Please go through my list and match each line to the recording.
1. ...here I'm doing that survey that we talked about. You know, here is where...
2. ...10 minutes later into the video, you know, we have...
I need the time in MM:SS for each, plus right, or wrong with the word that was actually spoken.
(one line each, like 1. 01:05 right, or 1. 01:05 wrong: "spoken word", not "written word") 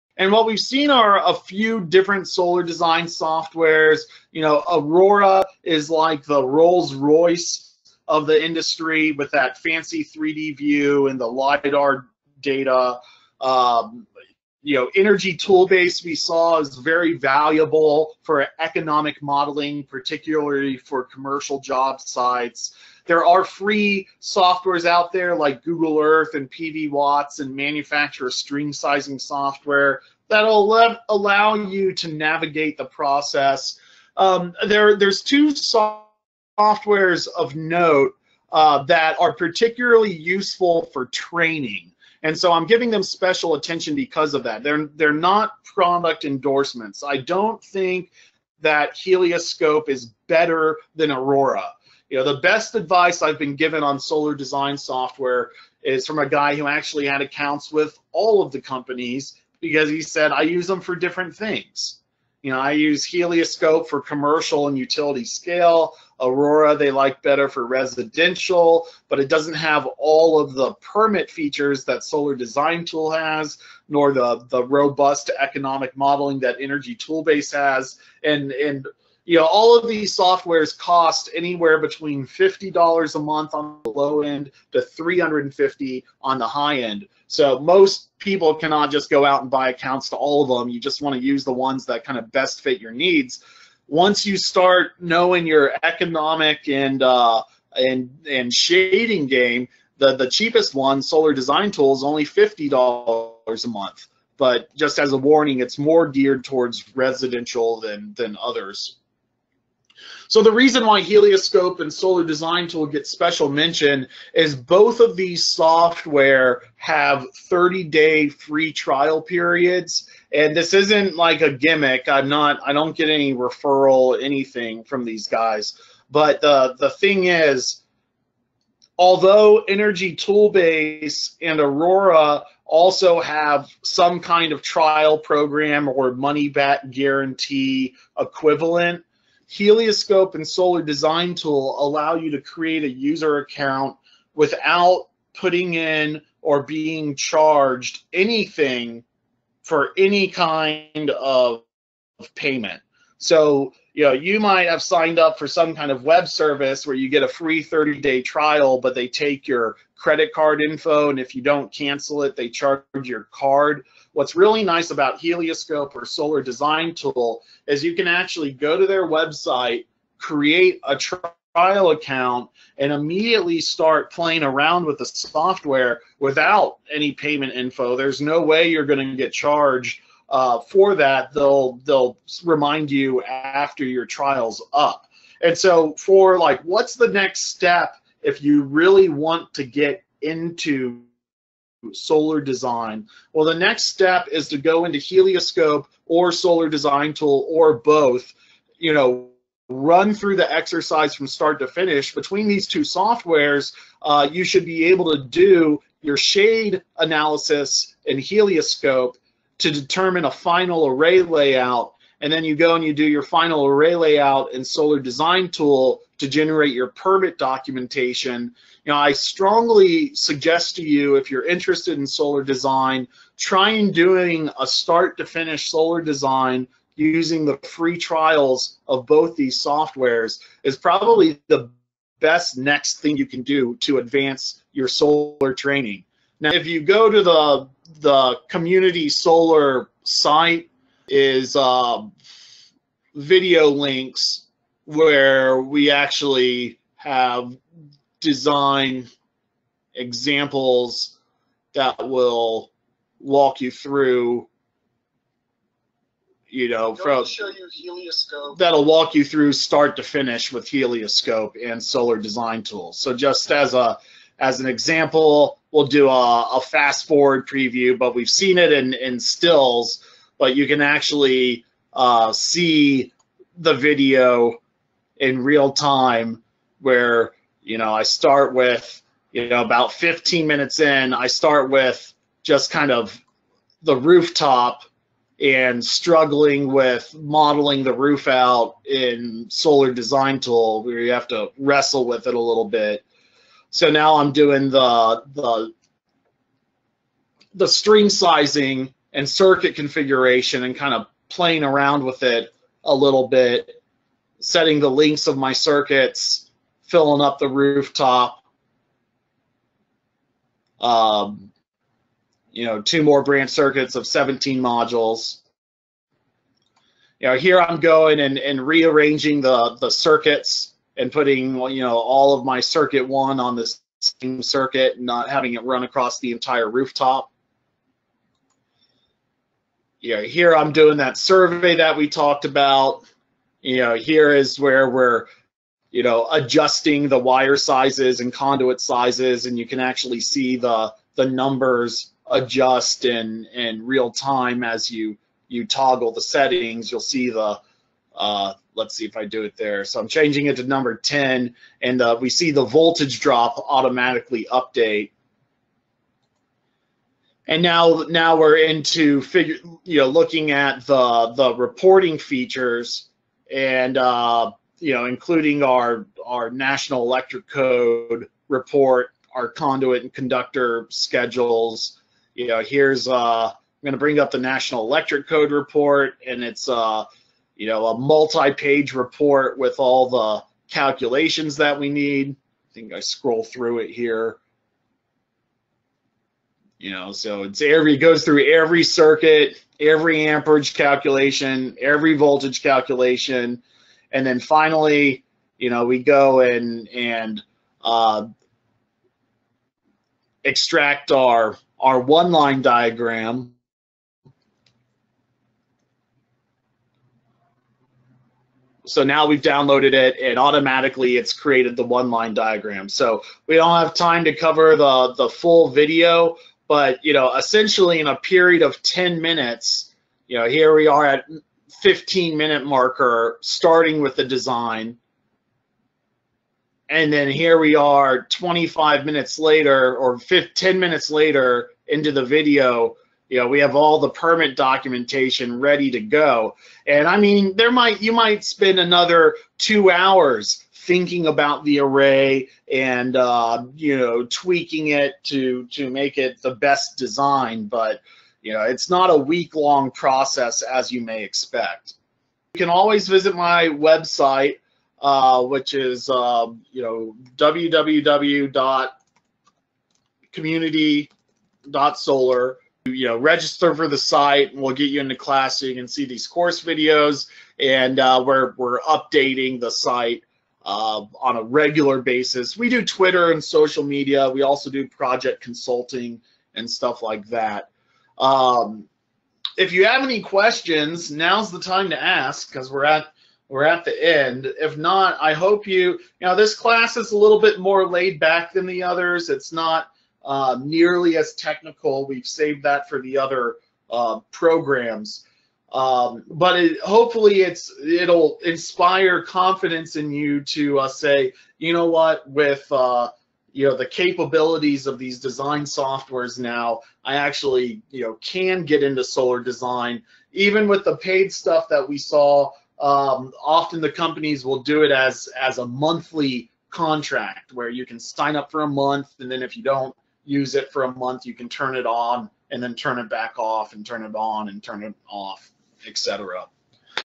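1. 05:30 right
2. 07:10 right.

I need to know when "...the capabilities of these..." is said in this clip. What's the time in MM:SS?
08:23.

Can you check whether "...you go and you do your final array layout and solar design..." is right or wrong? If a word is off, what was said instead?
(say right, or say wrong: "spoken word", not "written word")
right.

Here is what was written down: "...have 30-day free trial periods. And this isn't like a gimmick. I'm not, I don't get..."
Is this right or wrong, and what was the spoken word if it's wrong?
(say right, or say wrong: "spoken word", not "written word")
right.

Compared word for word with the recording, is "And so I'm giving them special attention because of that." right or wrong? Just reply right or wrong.
right.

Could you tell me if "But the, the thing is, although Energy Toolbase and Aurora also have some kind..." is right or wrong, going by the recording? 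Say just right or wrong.
right.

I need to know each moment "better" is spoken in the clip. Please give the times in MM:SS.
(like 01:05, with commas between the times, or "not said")
00:50, 01:07.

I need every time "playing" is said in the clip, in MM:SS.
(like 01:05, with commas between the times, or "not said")
02:54, 05:01.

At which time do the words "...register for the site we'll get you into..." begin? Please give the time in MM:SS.
07:43.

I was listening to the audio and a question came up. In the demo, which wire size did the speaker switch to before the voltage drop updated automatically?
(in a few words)
number 10.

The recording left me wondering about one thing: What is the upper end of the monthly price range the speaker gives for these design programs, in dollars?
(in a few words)
350.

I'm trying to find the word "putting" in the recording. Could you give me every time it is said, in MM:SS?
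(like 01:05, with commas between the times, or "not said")
02:25, 05:21.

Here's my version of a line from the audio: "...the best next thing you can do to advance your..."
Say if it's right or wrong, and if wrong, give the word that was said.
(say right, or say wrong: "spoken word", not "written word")
right.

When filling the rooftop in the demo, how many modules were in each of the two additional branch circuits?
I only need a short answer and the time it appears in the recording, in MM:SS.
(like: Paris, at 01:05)
17, at 05:14.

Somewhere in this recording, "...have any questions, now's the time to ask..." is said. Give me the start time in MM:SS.
07:59.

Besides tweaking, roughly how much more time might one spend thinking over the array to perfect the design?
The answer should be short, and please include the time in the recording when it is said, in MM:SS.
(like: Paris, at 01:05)
2 hours, at 07:19.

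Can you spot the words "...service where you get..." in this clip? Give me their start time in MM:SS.
02:36.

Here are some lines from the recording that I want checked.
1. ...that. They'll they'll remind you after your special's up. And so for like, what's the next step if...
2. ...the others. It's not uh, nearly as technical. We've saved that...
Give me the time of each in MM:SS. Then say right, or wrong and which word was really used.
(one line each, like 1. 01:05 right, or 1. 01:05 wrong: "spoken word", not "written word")
1. 03:00 wrong: "trial", not "special"
2. 08:08 right.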